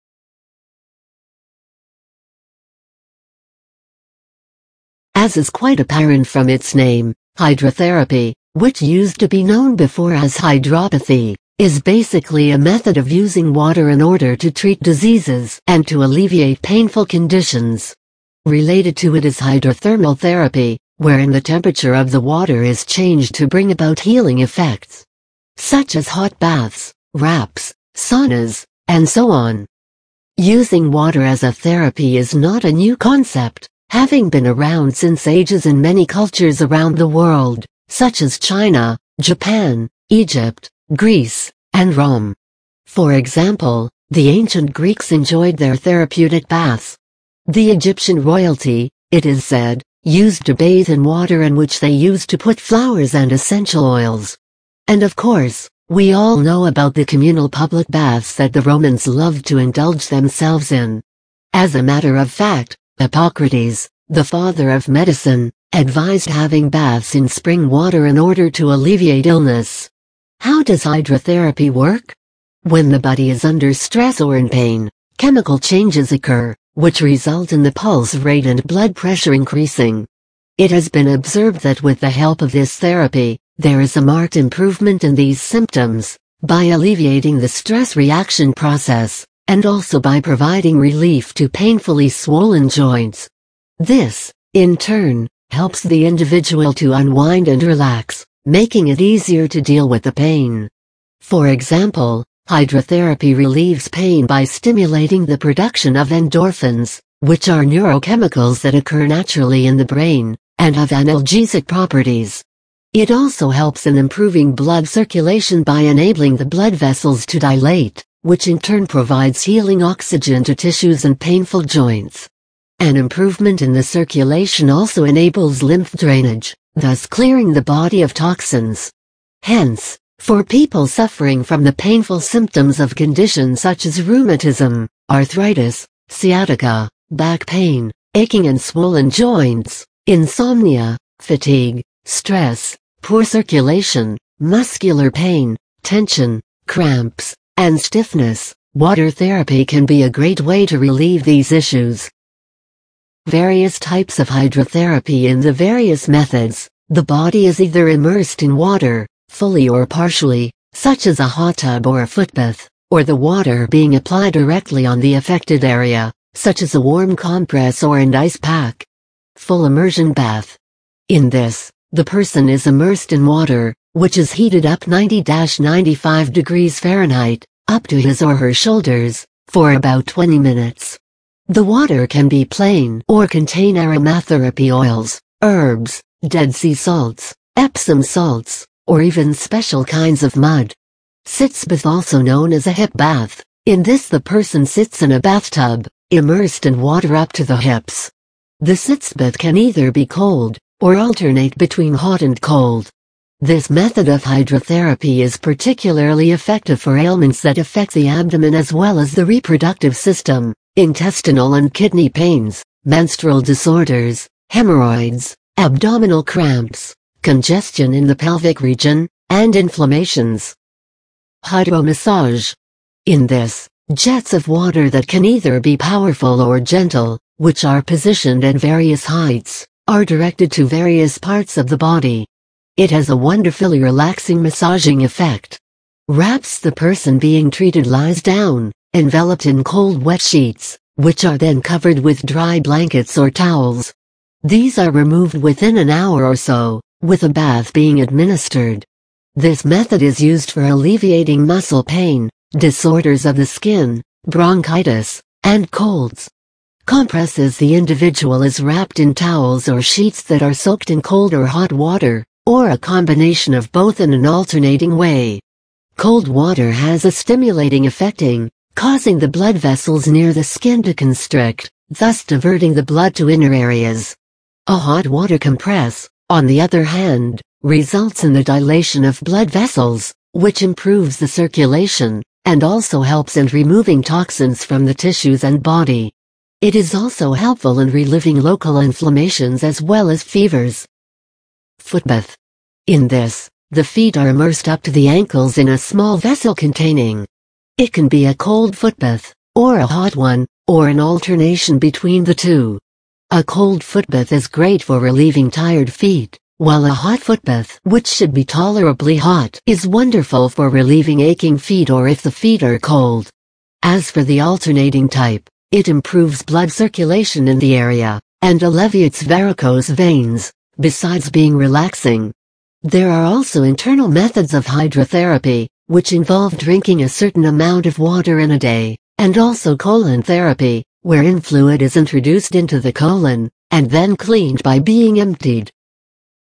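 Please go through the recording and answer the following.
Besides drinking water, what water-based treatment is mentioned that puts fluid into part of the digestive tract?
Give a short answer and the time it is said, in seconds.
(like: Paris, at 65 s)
colon therapy, at 329 s.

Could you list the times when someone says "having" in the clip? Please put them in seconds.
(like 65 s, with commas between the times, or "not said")
33 s, 66 s.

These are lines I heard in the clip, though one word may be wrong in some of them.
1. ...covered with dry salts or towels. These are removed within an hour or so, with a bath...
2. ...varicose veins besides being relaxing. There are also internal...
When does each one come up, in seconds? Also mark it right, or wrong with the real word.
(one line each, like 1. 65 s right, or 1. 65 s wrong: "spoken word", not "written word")
1. 241 s wrong: "blankets", not "salts"
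2. 319 s right.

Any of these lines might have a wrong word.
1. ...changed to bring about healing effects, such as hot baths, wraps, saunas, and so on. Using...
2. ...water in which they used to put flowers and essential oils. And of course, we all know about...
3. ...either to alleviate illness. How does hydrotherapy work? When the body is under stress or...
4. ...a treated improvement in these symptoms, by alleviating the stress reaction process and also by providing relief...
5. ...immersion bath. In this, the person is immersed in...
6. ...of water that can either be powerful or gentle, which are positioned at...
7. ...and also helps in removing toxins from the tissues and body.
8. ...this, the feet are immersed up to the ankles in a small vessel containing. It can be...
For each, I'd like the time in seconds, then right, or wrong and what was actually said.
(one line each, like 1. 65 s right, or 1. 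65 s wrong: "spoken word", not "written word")
1. 22 s right
2. 51 s right
3. 68 s wrong: "order", not "either"
4. 83 s wrong: "marked", not "treated"
5. 169 s right
6. 224 s right
7. 282 s right
8. 293 s right.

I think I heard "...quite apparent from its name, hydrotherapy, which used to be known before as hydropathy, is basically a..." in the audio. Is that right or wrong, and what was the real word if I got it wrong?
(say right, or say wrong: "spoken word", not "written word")
right.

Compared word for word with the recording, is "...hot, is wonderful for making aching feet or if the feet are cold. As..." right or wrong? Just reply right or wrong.
wrong.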